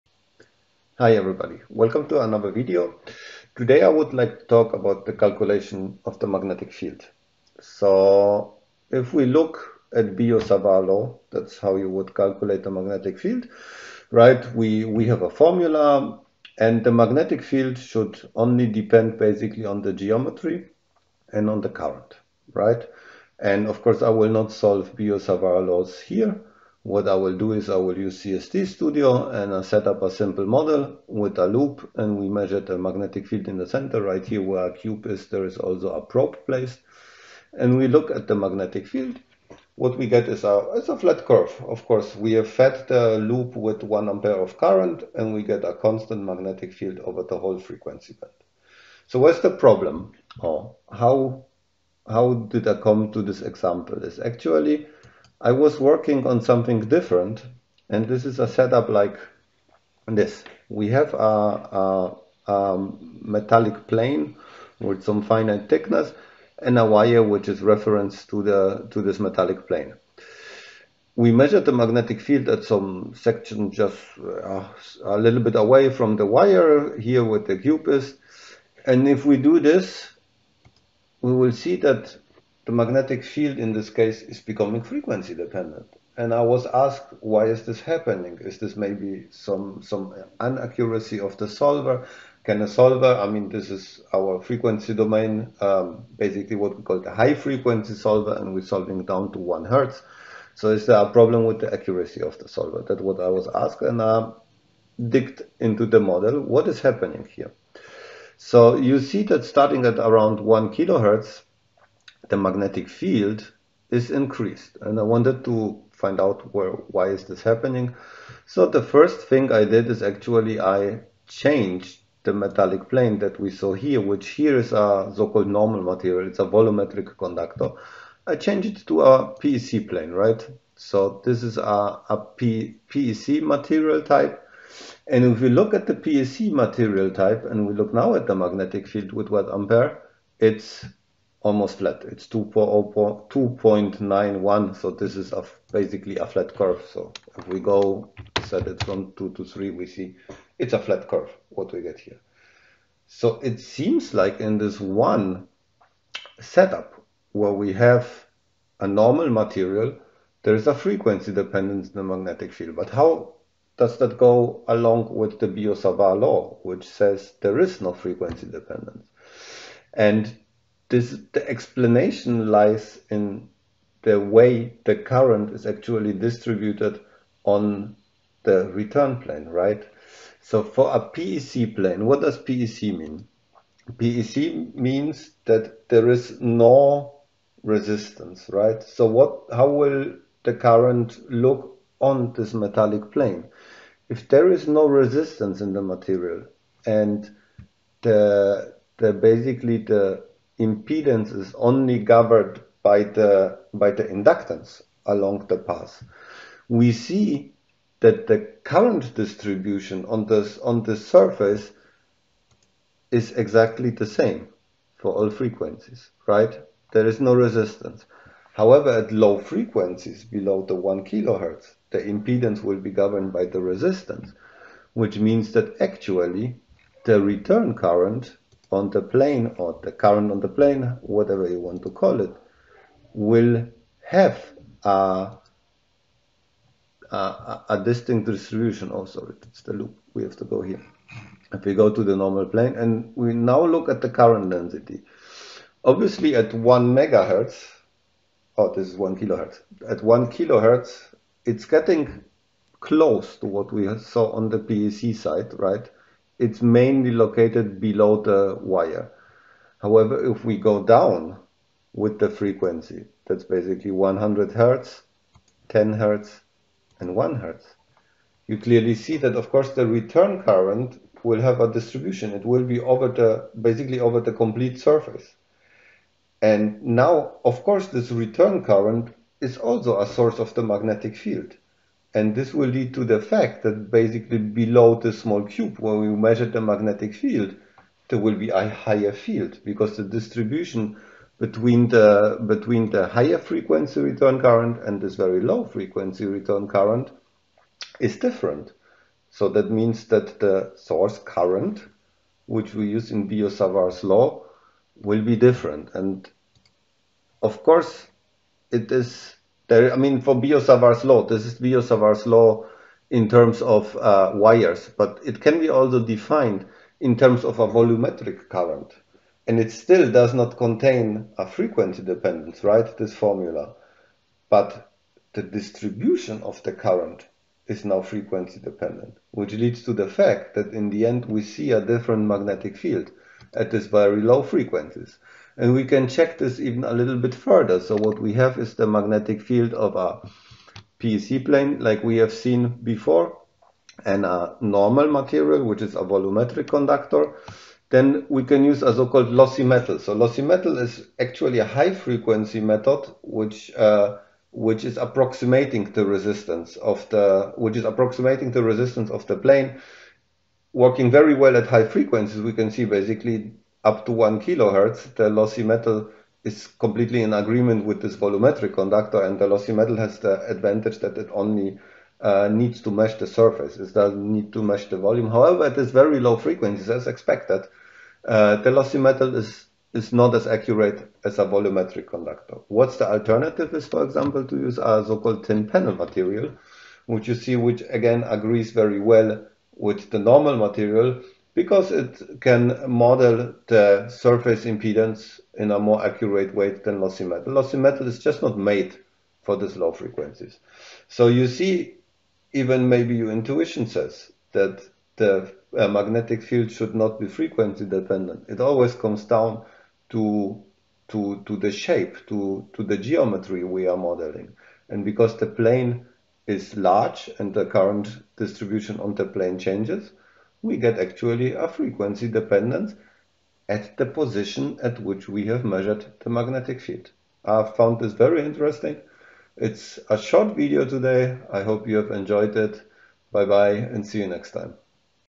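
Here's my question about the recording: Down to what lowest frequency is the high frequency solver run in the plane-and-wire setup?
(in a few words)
1 hertz.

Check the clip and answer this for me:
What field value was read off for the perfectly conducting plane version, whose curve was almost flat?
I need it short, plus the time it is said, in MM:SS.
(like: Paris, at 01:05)
2.91, at 02:22.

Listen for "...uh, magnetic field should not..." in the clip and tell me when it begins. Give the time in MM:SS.
06:45.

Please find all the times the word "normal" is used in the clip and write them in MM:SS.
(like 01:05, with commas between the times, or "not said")
02:05, 02:38, 04:02, 05:44, 06:30.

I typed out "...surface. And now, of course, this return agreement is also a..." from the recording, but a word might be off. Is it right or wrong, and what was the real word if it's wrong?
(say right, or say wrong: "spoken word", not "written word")
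wrong: "current", not "agreement".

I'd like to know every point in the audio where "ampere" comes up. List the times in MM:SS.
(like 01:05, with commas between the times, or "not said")
00:44, 02:19.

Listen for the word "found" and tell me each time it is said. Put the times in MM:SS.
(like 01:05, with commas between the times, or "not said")
07:07.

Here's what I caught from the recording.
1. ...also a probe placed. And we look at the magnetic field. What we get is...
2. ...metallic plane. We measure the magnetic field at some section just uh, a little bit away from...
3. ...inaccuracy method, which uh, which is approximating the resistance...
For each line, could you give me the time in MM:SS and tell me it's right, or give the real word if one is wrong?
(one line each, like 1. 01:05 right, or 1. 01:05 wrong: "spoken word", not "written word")
1. 00:35 right
2. 01:09 right
3. 05:51 wrong: "frequency", not "inaccuracy".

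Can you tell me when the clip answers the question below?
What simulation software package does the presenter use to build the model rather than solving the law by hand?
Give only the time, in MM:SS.
00:28.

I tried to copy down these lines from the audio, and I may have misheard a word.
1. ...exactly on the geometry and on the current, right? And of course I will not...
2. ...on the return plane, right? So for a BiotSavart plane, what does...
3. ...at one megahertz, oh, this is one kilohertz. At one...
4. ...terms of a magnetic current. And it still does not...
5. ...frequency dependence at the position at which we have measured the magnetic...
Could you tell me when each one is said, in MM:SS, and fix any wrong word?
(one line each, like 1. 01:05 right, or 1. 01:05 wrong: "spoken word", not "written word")
1. 00:19 wrong: "basically", not "exactly"
2. 02:57 wrong: "PEC", not "BiotSavart"
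3. 04:06 right
4. 05:17 wrong: "volumetric", not "magnetic"
5. 07:01 right.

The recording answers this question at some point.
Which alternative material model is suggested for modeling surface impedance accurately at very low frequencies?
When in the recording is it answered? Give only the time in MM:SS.
06:25.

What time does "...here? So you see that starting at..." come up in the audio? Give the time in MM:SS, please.
01:47.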